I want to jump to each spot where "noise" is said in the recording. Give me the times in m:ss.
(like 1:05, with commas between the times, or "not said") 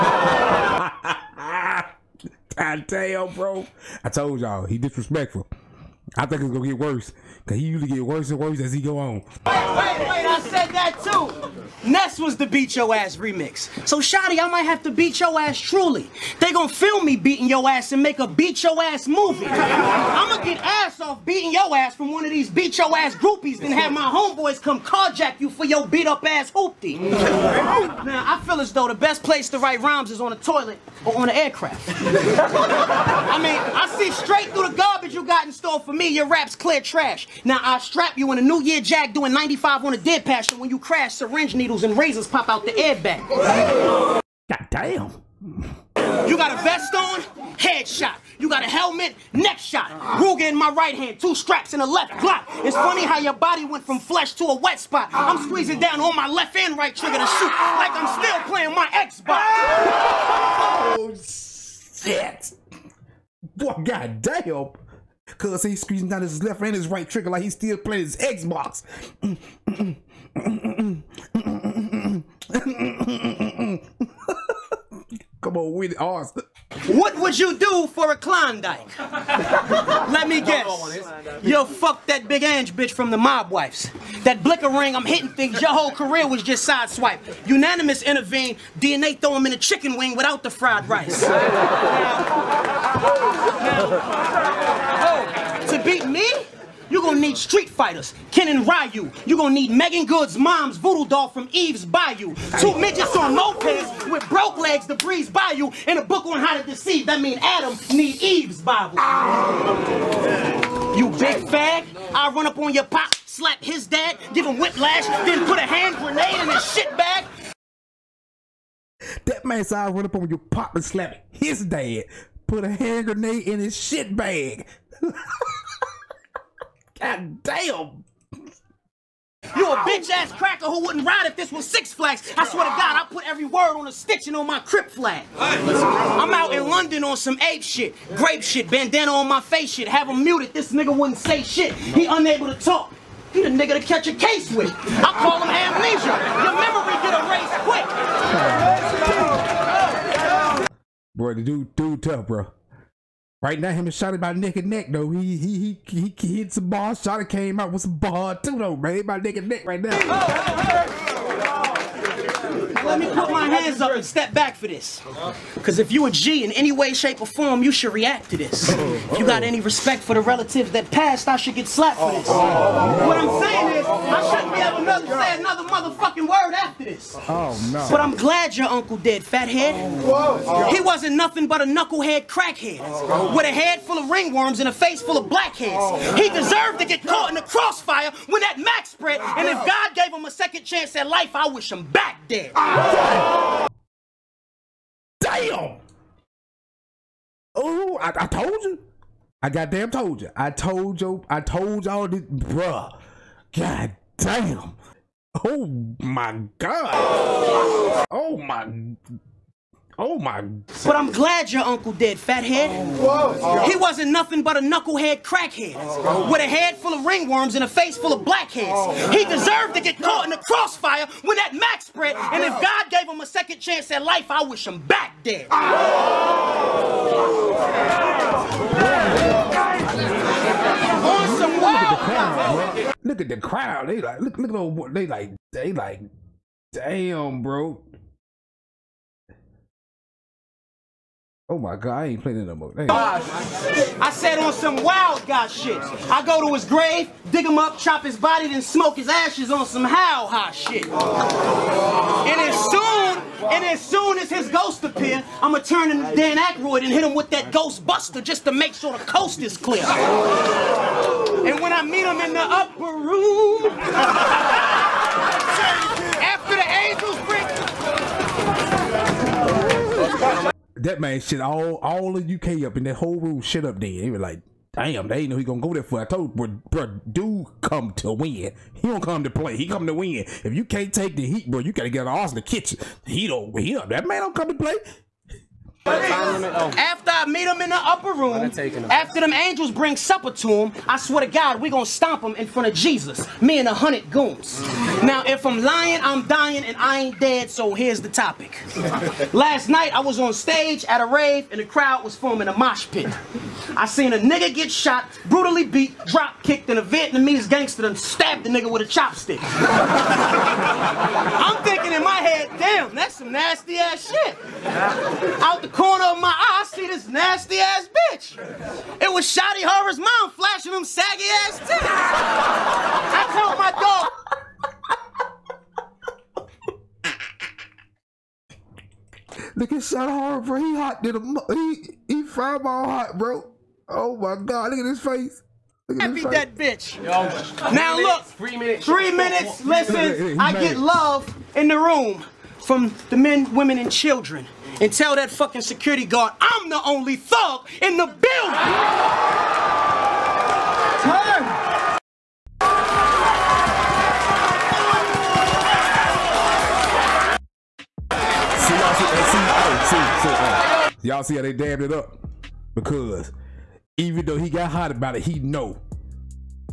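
not said.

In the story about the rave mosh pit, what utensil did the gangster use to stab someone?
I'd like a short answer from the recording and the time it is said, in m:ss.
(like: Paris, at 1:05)
chopstick, at 5:08.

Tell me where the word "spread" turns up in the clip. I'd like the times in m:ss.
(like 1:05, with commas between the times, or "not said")
3:08, 3:41.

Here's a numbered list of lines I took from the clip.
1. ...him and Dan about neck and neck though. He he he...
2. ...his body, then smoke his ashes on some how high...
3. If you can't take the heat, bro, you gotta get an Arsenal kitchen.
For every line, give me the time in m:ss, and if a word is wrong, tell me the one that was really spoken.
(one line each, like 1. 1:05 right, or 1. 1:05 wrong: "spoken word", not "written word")
1. 2:33 wrong: "Shotty", not "Dan"
2. 4:08 right
3. 4:40 right.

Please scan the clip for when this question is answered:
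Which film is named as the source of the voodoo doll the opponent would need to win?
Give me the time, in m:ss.
1:41.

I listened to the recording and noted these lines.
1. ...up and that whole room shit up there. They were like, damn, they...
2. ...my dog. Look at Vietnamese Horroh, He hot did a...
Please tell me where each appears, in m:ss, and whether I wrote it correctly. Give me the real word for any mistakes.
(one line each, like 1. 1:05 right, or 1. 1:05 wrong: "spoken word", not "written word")
1. 4:32 right
2. 5:23 wrong: "Shotty", not "Vietnamese".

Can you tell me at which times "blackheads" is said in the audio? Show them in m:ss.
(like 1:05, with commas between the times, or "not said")
3:05, 3:38.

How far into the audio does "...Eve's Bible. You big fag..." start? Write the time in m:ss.
1:48.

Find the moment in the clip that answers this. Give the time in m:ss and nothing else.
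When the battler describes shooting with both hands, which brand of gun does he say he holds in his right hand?
0:50.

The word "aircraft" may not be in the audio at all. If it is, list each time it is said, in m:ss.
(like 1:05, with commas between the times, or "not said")
0:31.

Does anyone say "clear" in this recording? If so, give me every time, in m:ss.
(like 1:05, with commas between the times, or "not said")
0:36, 4:19.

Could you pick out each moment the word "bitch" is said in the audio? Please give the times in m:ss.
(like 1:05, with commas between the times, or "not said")
1:22, 2:09, 5:18, 5:36.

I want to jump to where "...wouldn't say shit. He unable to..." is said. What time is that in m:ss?
2:20.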